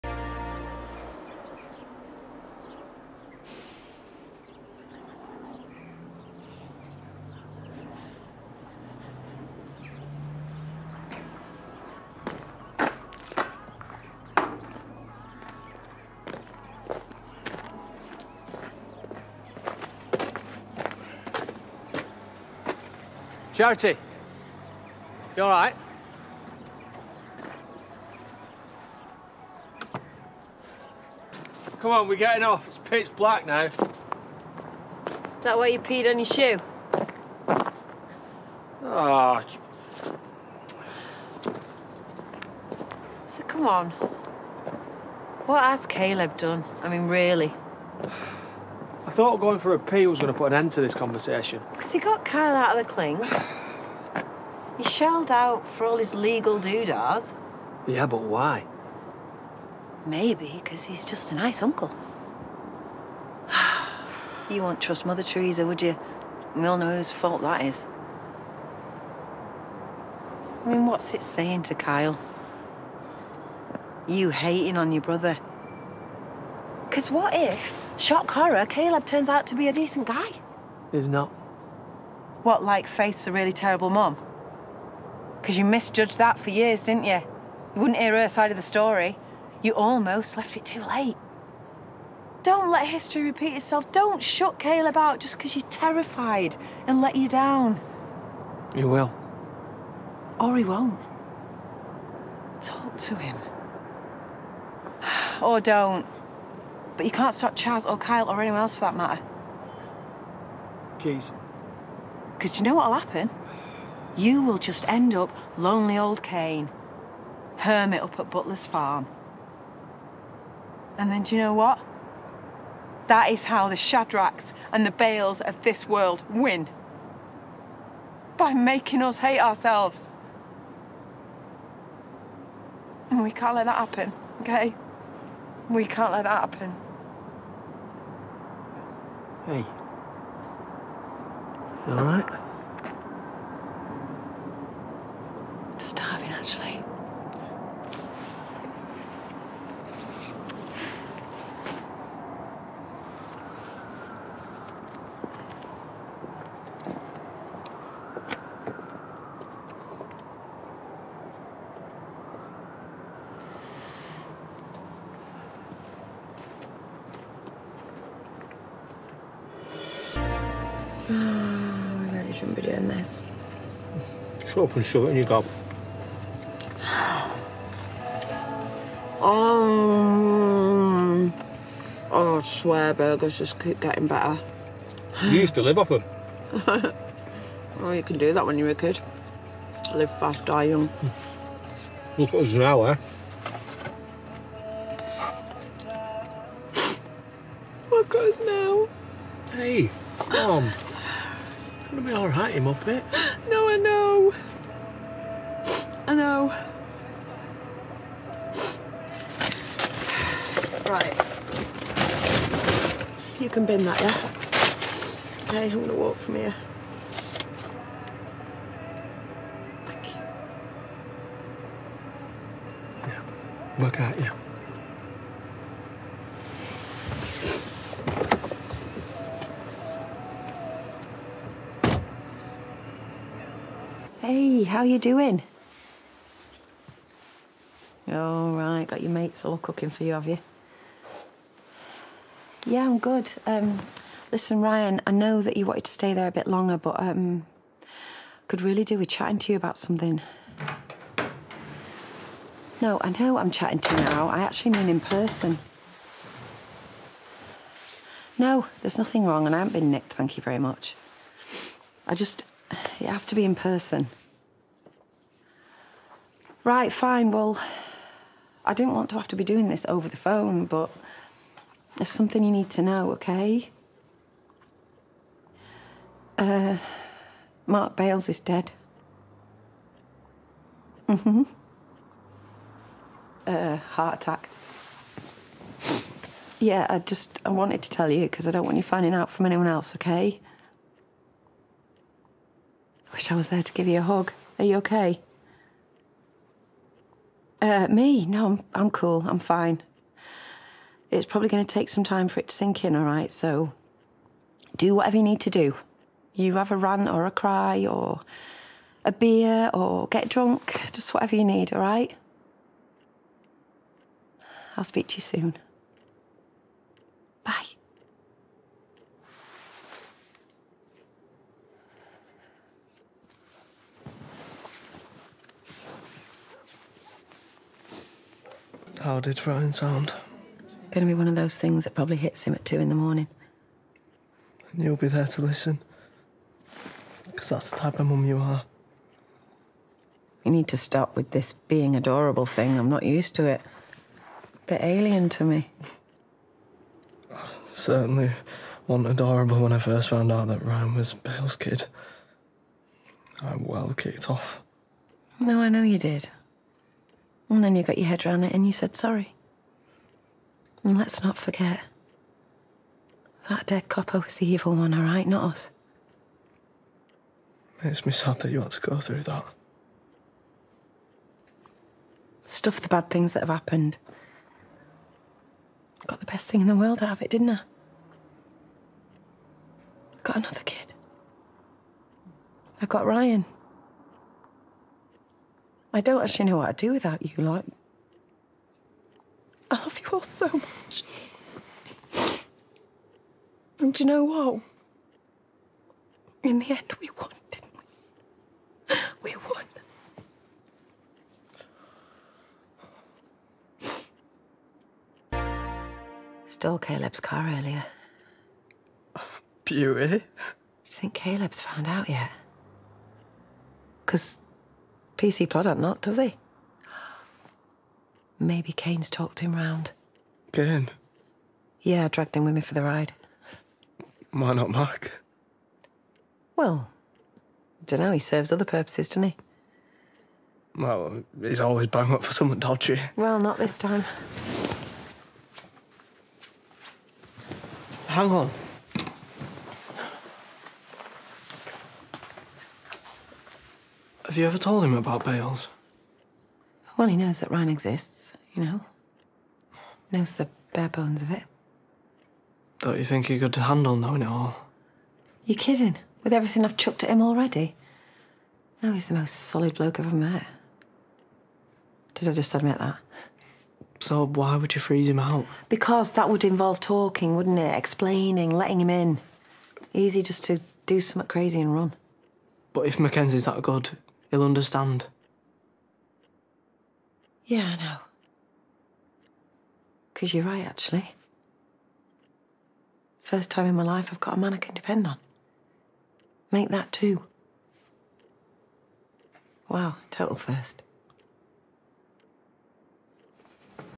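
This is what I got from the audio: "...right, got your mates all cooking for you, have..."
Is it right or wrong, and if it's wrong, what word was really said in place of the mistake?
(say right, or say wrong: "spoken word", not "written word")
right.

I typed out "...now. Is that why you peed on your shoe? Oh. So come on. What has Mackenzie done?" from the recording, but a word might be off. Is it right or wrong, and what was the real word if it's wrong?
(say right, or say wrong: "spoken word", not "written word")
wrong: "Caleb", not "Mackenzie".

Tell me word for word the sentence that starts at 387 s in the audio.
Like, I love you all so much.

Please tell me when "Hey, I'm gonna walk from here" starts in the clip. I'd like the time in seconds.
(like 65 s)
215 s.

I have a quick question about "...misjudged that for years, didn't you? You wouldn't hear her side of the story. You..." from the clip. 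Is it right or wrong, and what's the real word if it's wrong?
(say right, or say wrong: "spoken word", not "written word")
right.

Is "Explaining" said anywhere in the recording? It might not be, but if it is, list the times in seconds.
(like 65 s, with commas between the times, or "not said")
467 s.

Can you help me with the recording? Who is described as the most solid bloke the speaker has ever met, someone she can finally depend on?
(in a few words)
Mackenzie.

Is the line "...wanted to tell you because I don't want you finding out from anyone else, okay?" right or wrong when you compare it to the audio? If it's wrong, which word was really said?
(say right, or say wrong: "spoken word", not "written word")
right.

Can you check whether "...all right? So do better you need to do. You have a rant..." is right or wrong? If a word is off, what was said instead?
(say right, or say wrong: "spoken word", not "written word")
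wrong: "whatever", not "better".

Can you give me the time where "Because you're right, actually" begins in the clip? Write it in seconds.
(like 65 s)
480 s.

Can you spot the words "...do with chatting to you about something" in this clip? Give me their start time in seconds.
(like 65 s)
248 s.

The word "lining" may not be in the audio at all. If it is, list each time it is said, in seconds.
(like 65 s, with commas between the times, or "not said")
not said.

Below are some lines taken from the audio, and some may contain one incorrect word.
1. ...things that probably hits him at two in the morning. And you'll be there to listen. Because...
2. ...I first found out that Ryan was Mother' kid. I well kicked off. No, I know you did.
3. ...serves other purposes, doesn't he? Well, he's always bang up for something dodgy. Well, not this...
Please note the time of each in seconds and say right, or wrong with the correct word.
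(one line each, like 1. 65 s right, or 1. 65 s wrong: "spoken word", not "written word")
1. 331 s right
2. 349 s wrong: "Bails", not "Mother"
3. 428 s right.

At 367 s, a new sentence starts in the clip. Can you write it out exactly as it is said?
It makes me sad that you had to go through that.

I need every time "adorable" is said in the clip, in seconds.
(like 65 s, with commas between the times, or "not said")
341 s, 349 s.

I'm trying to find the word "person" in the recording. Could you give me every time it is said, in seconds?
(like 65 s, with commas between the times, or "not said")
254 s, 263 s.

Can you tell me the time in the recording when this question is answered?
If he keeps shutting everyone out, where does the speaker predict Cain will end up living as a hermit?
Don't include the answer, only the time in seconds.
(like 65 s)
118 s.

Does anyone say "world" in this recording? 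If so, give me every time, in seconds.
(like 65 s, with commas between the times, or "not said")
125 s, 376 s.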